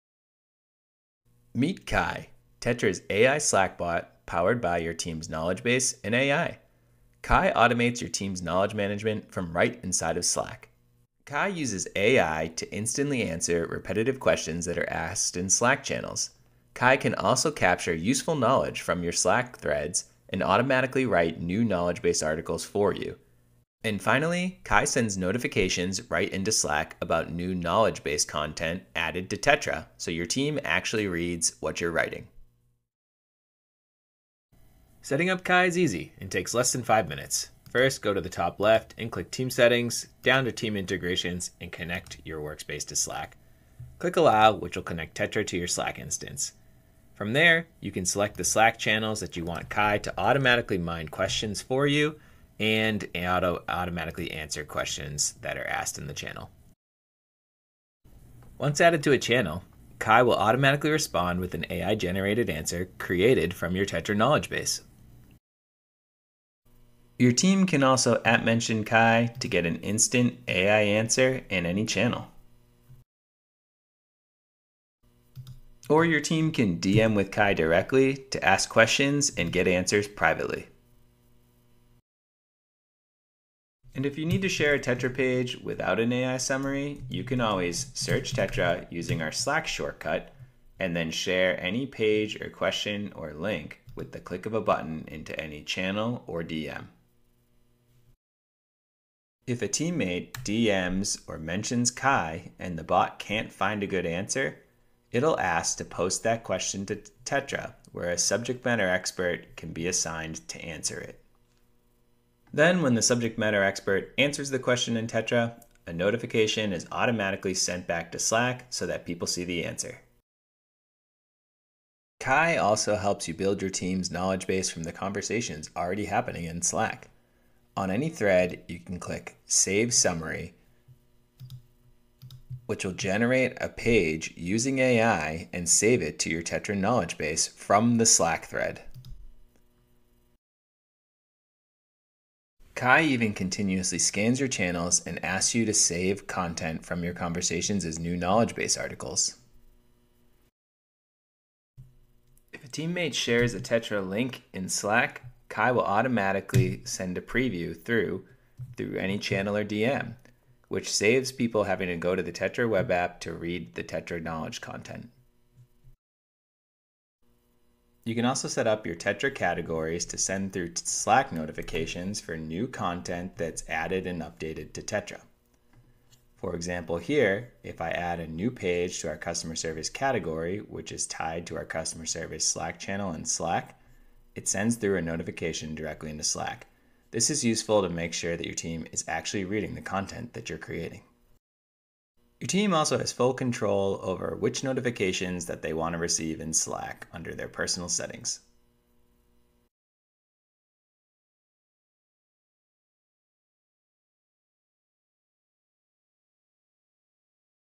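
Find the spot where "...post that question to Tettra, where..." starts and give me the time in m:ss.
1:45.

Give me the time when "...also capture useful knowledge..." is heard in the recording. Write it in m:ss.
0:17.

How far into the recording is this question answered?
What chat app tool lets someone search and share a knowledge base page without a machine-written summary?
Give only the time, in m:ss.
1:29.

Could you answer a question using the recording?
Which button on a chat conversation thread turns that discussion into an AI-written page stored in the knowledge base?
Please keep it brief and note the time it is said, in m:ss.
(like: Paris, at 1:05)
Save Summary, at 2:09.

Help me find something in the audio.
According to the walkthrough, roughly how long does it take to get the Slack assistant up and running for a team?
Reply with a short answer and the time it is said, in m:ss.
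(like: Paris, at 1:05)
less than 5 minutes, at 0:36.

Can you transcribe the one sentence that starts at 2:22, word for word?
Kai even continuously scans your channels and asks you to save content from your conversations as new knowledge base articles.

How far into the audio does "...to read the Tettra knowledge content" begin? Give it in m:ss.
2:43.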